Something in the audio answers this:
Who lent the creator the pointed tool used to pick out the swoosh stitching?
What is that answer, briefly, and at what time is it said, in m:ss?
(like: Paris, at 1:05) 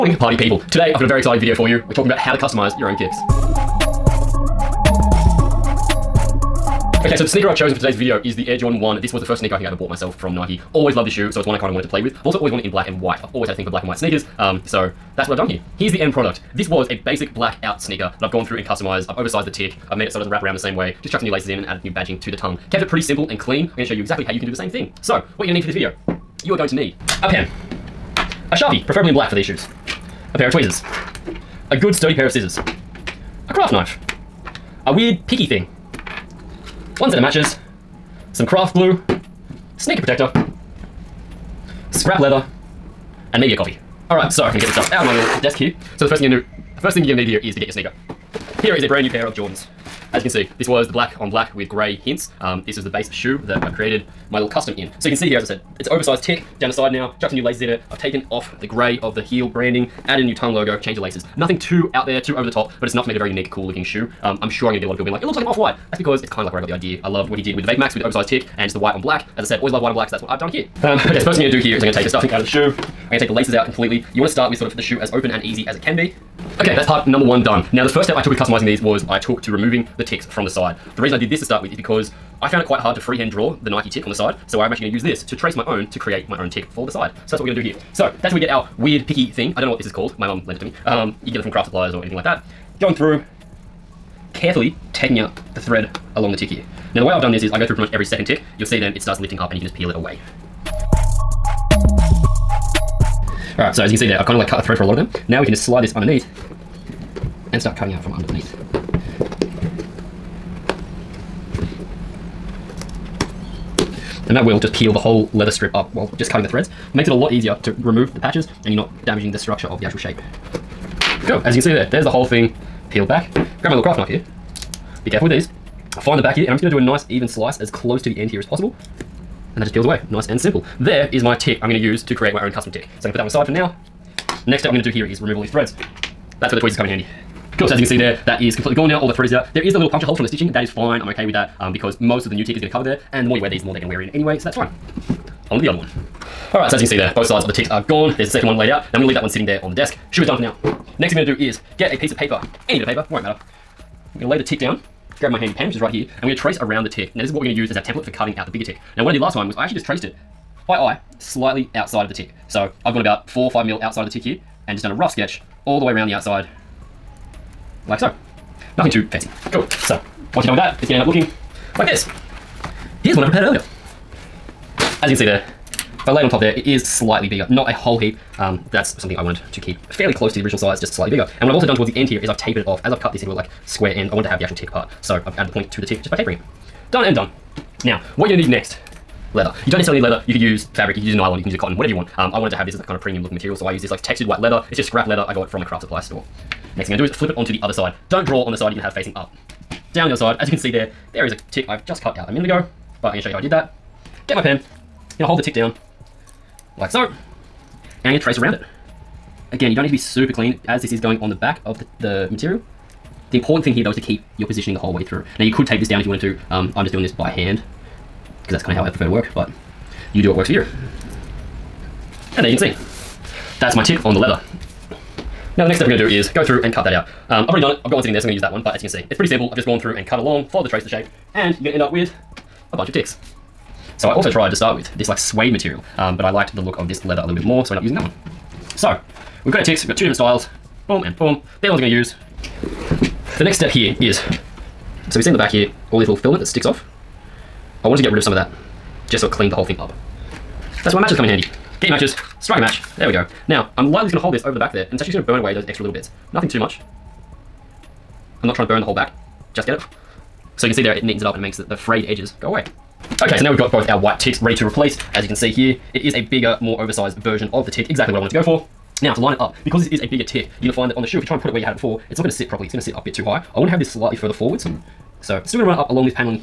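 My mum, at 1:30.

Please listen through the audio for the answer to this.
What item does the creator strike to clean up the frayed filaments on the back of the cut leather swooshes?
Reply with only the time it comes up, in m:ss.
4:12.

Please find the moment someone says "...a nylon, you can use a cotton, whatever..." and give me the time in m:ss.
3:11.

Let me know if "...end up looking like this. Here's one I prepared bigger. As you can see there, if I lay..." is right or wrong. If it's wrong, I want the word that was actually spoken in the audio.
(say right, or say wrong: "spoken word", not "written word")
wrong: "earlier", not "bigger".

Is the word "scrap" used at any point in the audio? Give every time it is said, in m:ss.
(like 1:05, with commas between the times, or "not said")
0:41, 3:14.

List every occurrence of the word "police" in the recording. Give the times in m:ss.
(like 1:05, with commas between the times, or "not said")
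not said.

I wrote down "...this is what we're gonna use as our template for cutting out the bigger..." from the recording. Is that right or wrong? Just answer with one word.
right.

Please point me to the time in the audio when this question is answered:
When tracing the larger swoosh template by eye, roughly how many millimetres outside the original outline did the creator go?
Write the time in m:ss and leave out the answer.
2:43.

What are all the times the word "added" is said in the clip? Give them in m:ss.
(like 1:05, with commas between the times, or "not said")
0:21, 1:00, 3:05.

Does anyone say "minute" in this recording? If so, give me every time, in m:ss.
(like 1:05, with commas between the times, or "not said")
3:22.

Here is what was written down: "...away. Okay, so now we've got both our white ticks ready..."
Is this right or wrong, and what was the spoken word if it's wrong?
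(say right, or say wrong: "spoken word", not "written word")
right.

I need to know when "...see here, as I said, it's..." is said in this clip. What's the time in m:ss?
0:55.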